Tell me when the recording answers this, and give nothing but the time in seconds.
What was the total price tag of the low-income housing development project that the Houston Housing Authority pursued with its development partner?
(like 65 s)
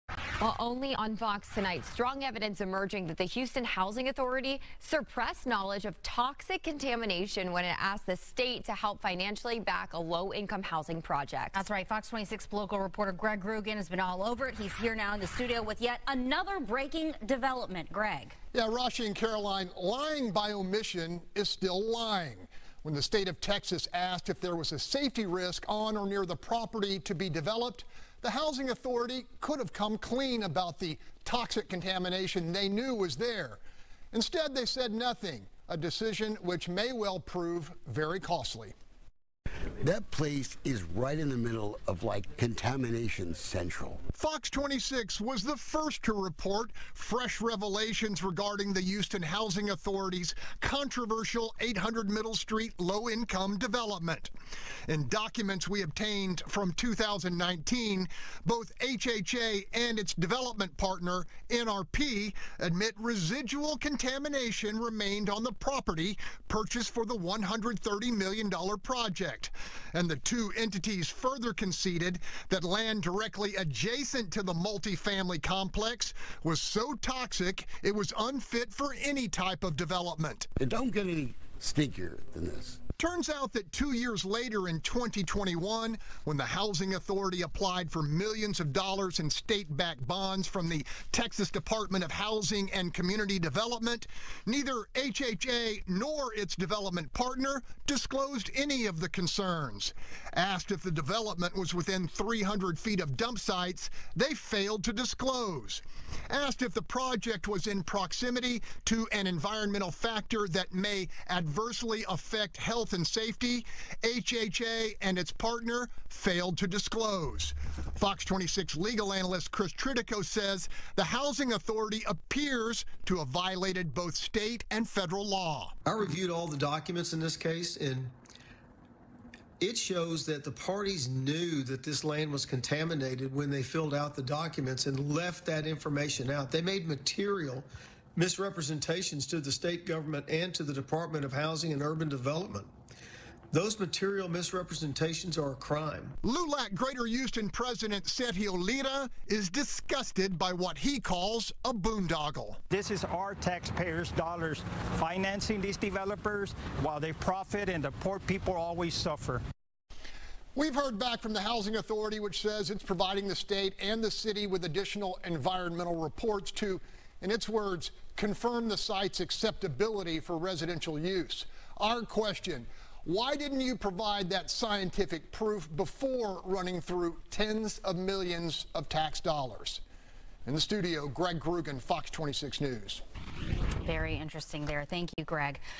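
67 s.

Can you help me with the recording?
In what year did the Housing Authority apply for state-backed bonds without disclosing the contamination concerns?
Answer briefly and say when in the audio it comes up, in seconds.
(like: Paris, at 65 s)
2021, at 84 s.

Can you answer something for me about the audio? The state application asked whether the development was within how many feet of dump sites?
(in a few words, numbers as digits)
300 feet.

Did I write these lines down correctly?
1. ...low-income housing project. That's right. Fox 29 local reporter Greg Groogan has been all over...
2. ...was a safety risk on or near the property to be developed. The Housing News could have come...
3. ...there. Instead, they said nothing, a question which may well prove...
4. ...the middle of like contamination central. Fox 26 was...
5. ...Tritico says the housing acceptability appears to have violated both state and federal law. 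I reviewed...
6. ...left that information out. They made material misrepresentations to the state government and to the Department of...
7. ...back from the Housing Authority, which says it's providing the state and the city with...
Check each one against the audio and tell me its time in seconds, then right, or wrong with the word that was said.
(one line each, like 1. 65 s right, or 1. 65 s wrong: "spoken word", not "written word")
1. 9 s wrong: "26", not "29"
2. 24 s wrong: "Authority", not "News"
3. 33 s wrong: "decision", not "question"
4. 41 s right
5. 119 s wrong: "authority", not "acceptability"
6. 135 s right
7. 160 s right.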